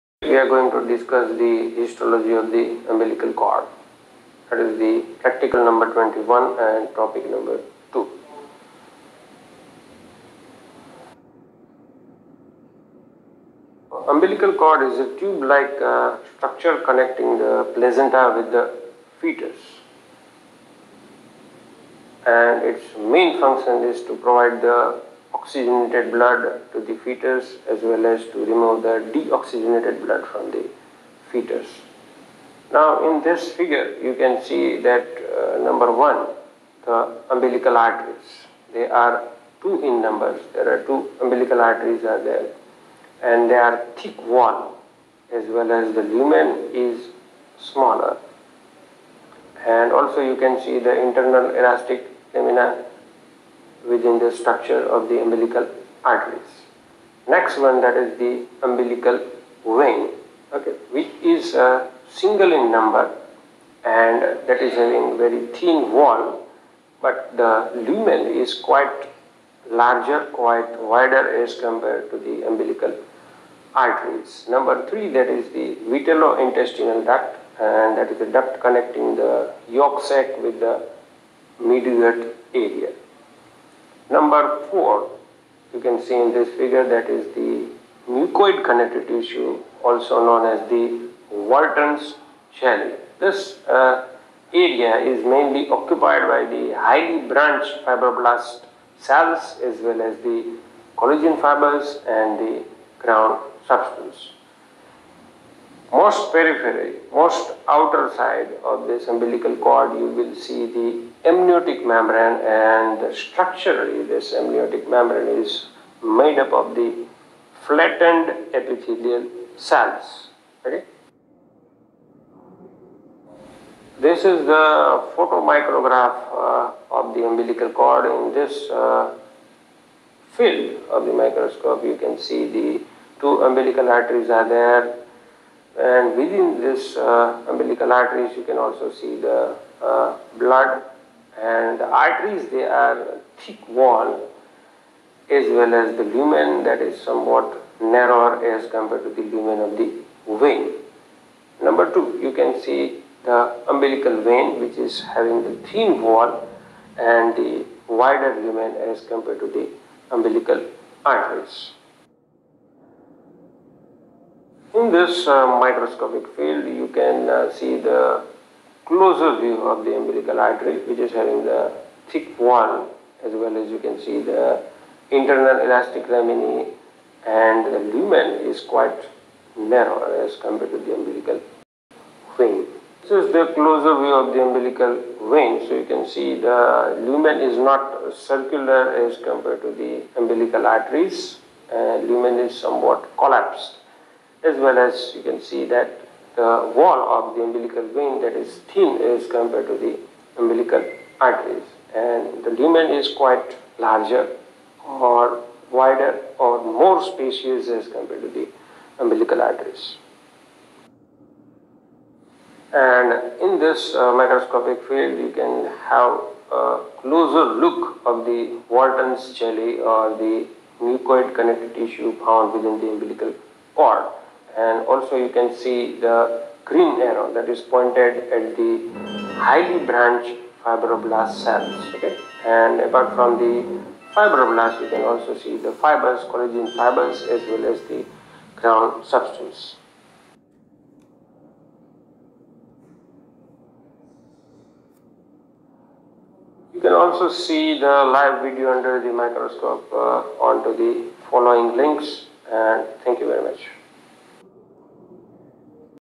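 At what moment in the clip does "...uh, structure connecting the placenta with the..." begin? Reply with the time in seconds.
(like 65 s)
15 s.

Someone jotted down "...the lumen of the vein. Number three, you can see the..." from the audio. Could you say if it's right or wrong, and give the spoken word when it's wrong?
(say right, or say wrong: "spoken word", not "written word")
wrong: "two", not "three".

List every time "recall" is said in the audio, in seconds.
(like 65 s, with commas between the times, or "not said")
not said.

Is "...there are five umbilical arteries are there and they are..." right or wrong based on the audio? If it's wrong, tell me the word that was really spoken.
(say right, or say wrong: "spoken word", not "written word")
wrong: "two", not "five".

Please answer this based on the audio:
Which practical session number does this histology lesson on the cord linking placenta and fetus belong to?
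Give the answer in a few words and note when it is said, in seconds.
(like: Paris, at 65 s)
21, at 5 s.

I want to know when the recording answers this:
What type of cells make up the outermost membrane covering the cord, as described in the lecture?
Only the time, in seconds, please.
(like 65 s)
117 s.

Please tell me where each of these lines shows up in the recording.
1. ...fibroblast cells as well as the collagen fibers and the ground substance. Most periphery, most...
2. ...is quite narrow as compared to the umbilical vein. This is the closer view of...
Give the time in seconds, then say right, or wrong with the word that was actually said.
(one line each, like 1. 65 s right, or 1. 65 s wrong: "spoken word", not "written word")
1. 97 s right
2. 178 s right.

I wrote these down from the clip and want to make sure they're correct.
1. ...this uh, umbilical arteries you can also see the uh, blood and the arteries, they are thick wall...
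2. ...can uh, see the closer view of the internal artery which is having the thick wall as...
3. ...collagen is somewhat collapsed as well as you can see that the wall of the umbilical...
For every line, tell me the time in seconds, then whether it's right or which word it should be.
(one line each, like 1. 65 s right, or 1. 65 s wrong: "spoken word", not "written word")
1. 136 s right
2. 166 s wrong: "umbilical", not "internal"
3. 192 s wrong: "lumen", not "collagen".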